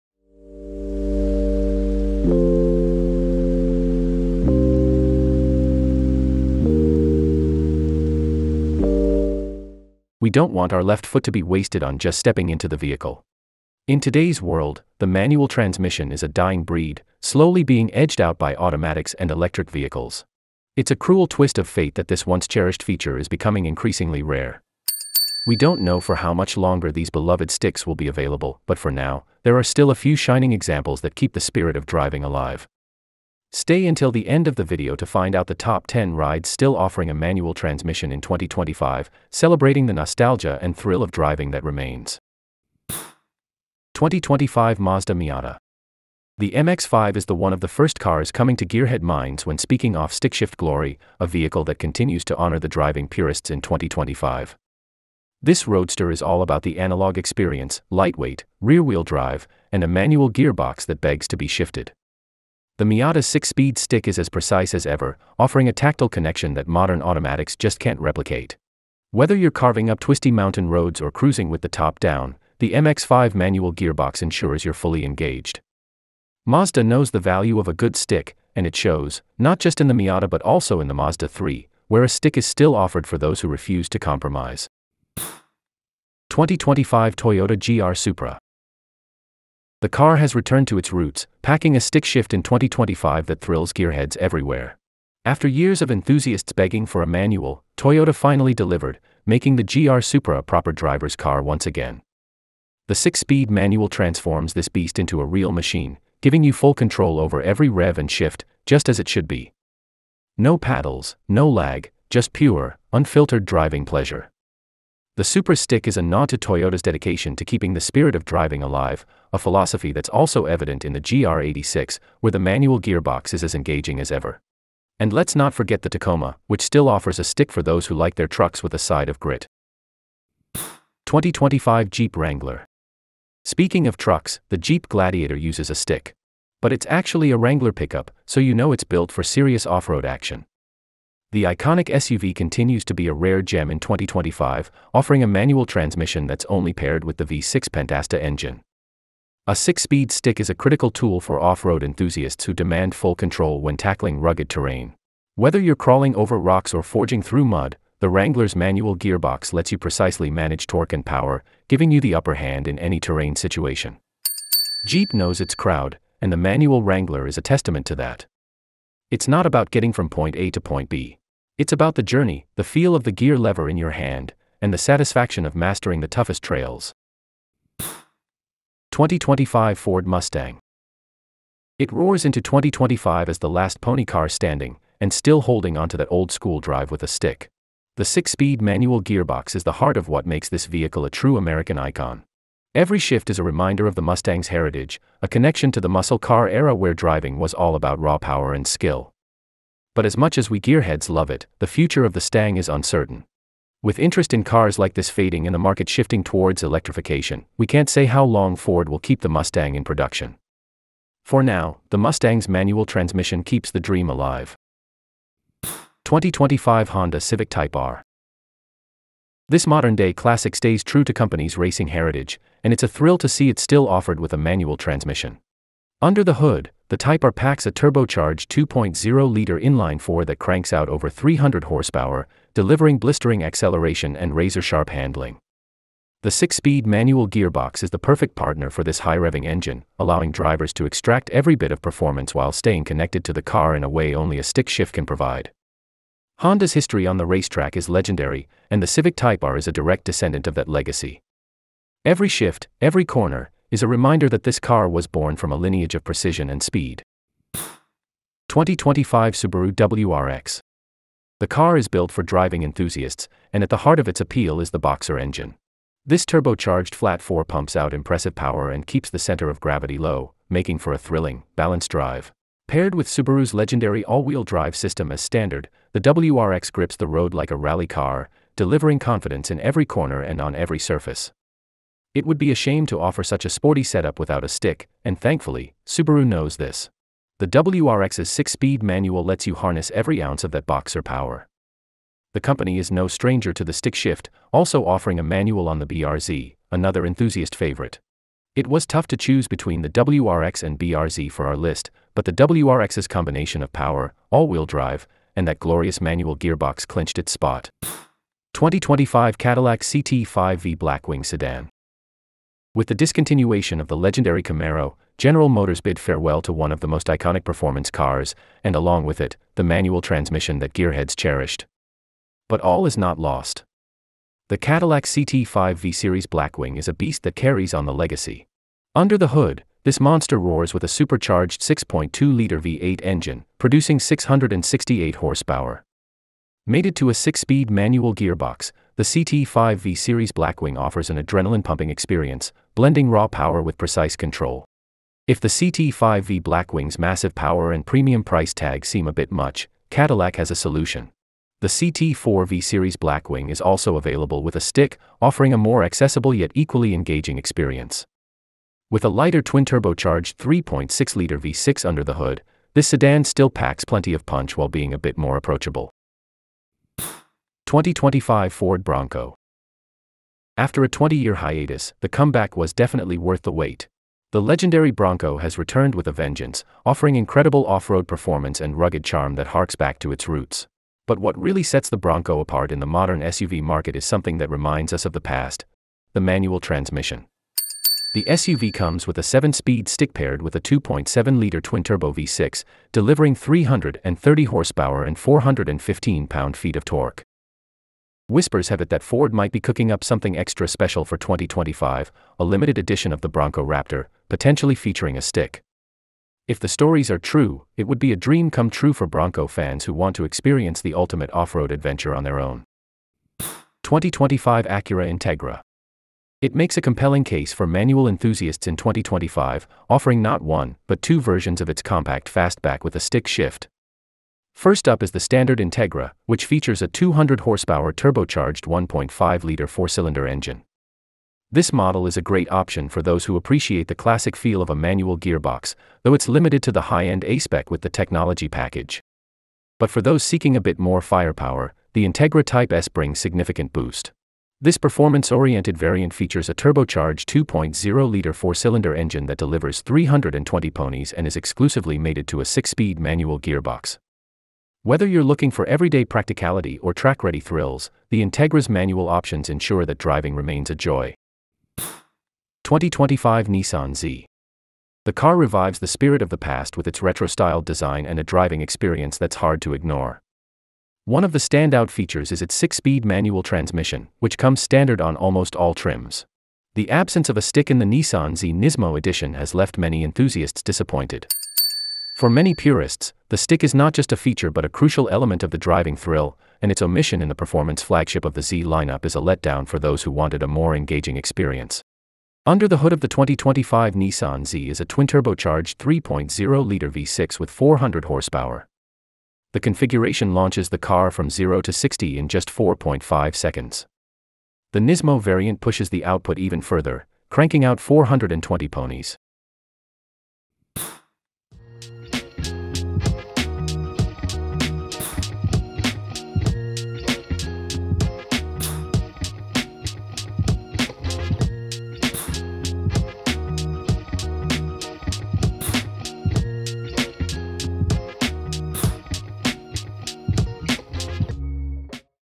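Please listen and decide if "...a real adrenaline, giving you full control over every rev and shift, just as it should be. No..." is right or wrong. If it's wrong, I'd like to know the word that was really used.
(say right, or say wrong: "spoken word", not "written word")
wrong: "machine", not "adrenaline".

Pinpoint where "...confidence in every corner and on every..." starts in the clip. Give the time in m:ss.
4:38.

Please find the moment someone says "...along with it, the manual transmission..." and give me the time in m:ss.
5:18.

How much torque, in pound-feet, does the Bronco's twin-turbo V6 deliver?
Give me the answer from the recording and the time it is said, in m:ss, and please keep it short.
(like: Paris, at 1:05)
415, at 6:35.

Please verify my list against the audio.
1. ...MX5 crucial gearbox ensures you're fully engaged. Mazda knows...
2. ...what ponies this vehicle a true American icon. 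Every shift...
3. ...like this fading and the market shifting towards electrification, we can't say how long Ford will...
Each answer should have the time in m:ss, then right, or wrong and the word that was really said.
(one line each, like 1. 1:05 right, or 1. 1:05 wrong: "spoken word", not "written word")
1. 1:12 wrong: "manual", not "crucial"
2. 3:10 wrong: "makes", not "ponies"
3. 3:24 right.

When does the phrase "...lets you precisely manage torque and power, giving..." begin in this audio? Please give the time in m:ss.
2:39.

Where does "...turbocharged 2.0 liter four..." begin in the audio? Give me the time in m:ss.
7:26.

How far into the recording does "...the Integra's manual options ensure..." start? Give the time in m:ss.
7:38.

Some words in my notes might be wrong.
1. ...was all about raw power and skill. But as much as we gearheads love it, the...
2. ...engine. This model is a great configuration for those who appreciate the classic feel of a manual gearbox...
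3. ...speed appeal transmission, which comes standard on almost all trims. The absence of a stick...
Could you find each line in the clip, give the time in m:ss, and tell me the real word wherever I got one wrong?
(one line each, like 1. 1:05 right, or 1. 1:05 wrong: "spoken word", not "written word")
1. 3:17 right
2. 7:10 wrong: "option", not "configuration"
3. 7:52 wrong: "manual", not "appeal".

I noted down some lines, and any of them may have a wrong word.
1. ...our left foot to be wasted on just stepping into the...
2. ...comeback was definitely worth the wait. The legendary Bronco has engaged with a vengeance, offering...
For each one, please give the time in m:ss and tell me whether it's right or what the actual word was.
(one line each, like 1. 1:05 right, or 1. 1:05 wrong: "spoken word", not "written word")
1. 0:10 right
2. 6:12 wrong: "returned", not "engaged".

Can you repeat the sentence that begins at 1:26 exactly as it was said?
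2025 Toyota GR Supra the car has returned to its roots, packing a stick shift in 2025 that thrills gearheads everywhere.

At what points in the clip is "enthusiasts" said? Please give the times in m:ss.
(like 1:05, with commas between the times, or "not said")
1:35, 2:31, 4:22, 4:57, 6:58, 8:00.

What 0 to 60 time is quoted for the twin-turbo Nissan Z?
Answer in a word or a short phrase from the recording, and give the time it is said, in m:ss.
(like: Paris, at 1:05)
4.5 seconds, at 8:22.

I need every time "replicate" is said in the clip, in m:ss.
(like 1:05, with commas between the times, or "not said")
1:07.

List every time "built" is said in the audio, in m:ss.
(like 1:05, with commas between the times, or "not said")
2:18, 4:21.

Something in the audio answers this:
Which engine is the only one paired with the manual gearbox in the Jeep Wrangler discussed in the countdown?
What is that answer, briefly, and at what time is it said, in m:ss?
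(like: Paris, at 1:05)
V6 Pentastar, at 2:27.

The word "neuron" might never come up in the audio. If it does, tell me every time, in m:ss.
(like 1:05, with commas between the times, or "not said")
not said.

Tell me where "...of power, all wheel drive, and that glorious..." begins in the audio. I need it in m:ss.
5:03.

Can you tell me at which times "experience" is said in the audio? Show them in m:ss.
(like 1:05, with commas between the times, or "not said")
0:57, 5:41, 5:57, 6:50, 7:48, 8:11.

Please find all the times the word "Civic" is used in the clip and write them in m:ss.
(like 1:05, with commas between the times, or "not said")
3:37, 4:08.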